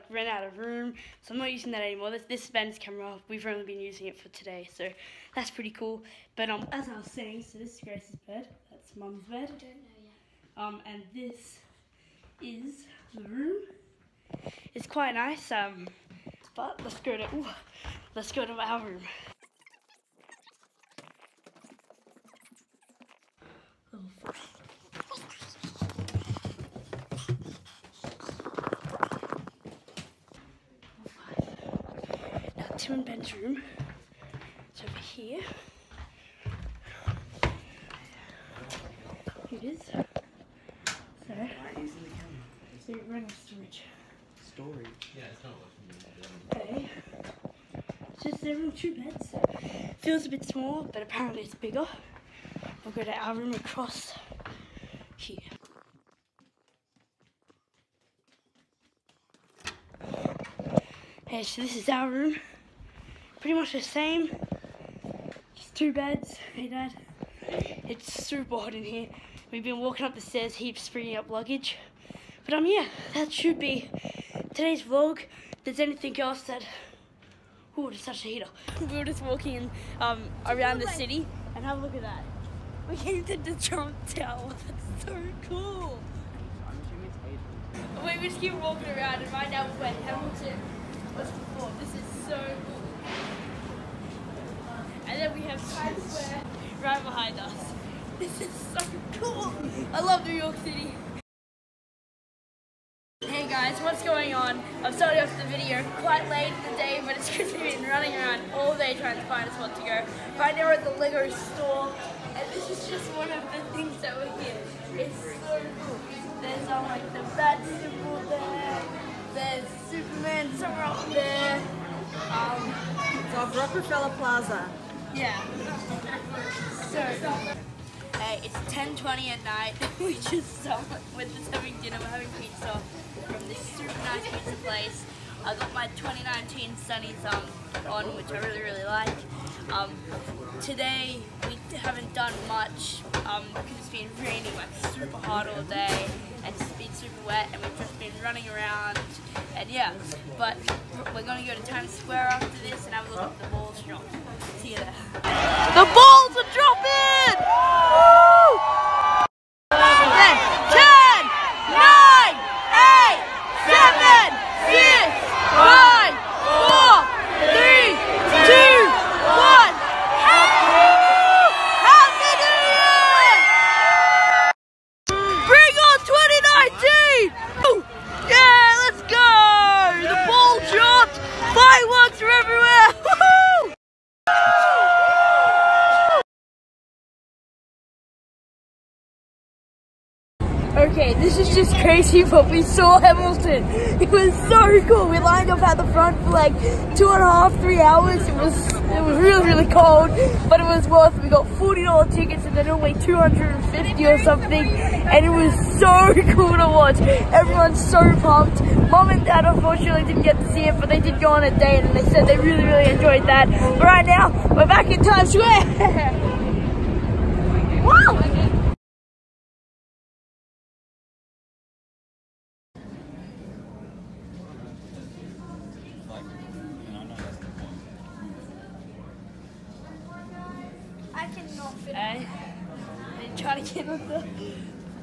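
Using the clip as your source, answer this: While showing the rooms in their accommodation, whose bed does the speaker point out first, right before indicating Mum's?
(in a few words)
Grace.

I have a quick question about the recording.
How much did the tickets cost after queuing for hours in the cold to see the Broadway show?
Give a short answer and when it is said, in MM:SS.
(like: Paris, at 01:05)
$40, at 03:21.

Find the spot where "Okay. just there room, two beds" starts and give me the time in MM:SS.
00:47.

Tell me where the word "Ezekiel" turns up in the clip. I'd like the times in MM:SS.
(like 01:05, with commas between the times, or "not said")
not said.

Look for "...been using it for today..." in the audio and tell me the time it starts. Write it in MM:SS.
00:03.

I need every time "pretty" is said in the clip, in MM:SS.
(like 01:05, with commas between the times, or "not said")
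00:05, 01:03.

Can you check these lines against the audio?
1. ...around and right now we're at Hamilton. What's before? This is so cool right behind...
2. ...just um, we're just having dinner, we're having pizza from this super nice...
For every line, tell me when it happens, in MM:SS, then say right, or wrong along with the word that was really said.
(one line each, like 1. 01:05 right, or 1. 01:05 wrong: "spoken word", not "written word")
1. 01:28 right
2. 02:10 right.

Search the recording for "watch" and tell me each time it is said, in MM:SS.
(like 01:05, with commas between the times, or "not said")
03:26.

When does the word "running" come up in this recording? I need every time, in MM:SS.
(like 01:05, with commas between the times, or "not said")
00:43, 01:47, 02:28.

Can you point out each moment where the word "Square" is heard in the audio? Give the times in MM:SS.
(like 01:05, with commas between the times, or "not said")
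02:31, 03:35.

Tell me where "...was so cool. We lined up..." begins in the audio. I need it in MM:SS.
03:14.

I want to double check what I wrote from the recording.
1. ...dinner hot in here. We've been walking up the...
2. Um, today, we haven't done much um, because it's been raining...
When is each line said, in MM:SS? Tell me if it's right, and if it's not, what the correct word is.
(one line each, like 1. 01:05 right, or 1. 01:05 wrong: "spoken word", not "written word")
1. 01:08 wrong: "super", not "dinner"
2. 02:19 right.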